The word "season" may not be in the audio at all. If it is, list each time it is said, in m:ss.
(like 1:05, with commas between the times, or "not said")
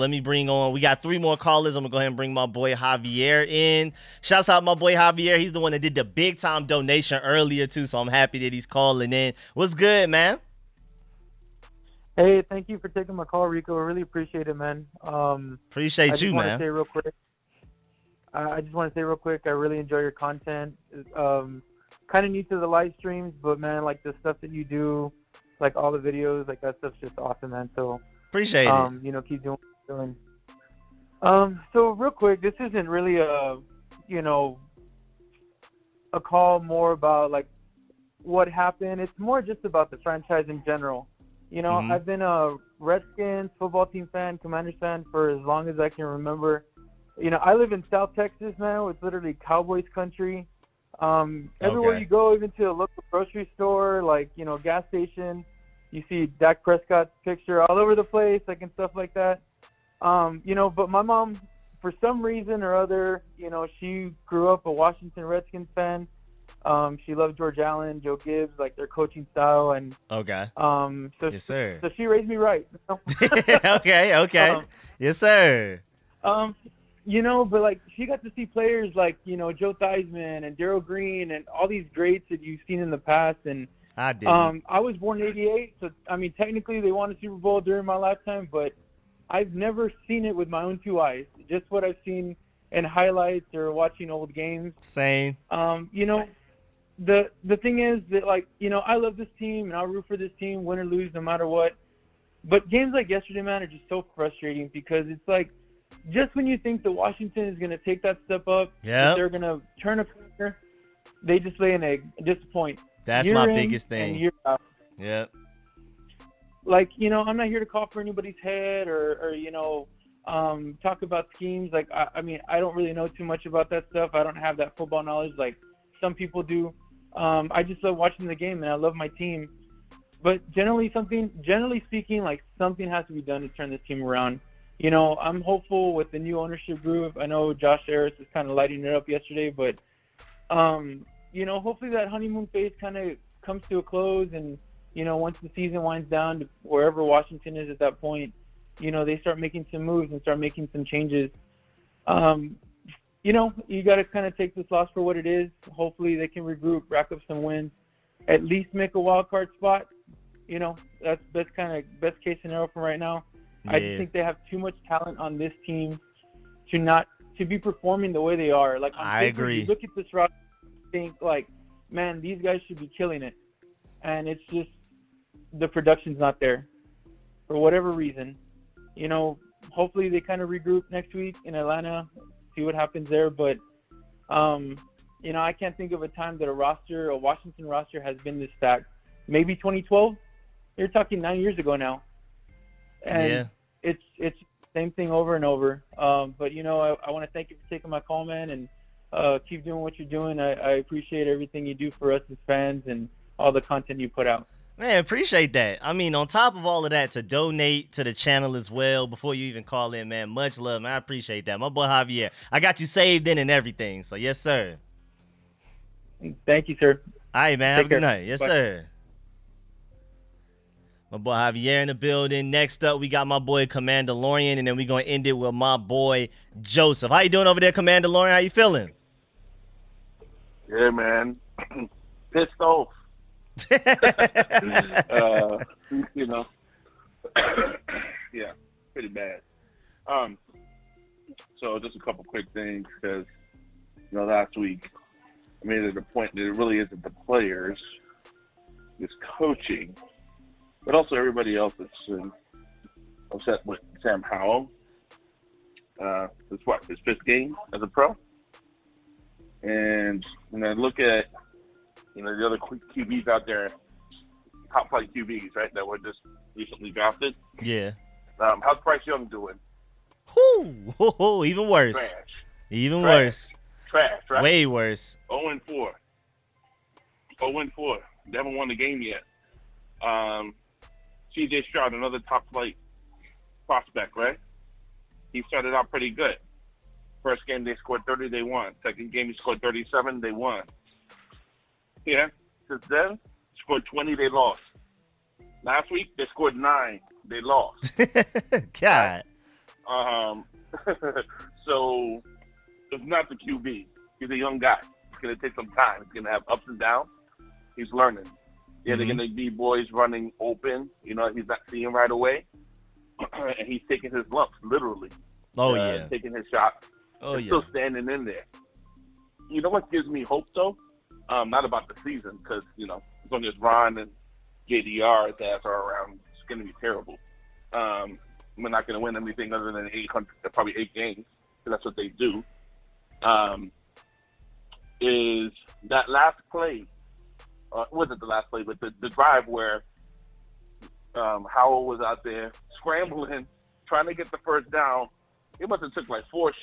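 2:25, 5:22.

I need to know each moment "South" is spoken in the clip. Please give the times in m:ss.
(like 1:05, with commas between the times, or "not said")
0:47.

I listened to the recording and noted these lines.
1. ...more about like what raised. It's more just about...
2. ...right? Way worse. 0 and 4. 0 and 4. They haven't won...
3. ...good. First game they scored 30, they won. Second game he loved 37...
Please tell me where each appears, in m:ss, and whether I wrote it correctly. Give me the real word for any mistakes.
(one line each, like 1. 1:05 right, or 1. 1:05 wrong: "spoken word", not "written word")
1. 0:36 wrong: "happened", not "raised"
2. 4:34 right
3. 4:46 wrong: "scored", not "loved".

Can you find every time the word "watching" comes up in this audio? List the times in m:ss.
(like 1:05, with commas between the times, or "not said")
1:33, 2:07.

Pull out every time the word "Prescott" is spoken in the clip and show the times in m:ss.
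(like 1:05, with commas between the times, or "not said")
0:56.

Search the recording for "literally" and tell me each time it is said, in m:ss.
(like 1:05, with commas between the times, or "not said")
0:49, 5:14.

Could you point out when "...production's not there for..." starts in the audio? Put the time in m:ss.
2:55.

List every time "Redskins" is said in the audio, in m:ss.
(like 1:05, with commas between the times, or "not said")
0:42, 1:05.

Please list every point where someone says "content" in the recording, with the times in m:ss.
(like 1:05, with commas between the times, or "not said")
0:20, 3:23.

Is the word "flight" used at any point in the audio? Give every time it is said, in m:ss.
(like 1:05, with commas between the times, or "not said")
4:24, 4:42.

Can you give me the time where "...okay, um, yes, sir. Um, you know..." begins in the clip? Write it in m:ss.
1:14.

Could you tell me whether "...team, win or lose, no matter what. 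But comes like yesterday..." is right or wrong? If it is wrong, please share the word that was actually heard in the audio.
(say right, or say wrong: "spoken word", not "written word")
wrong: "games", not "comes".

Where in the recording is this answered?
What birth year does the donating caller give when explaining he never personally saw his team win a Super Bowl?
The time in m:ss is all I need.
1:25.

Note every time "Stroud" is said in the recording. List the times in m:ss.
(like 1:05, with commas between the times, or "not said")
4:41.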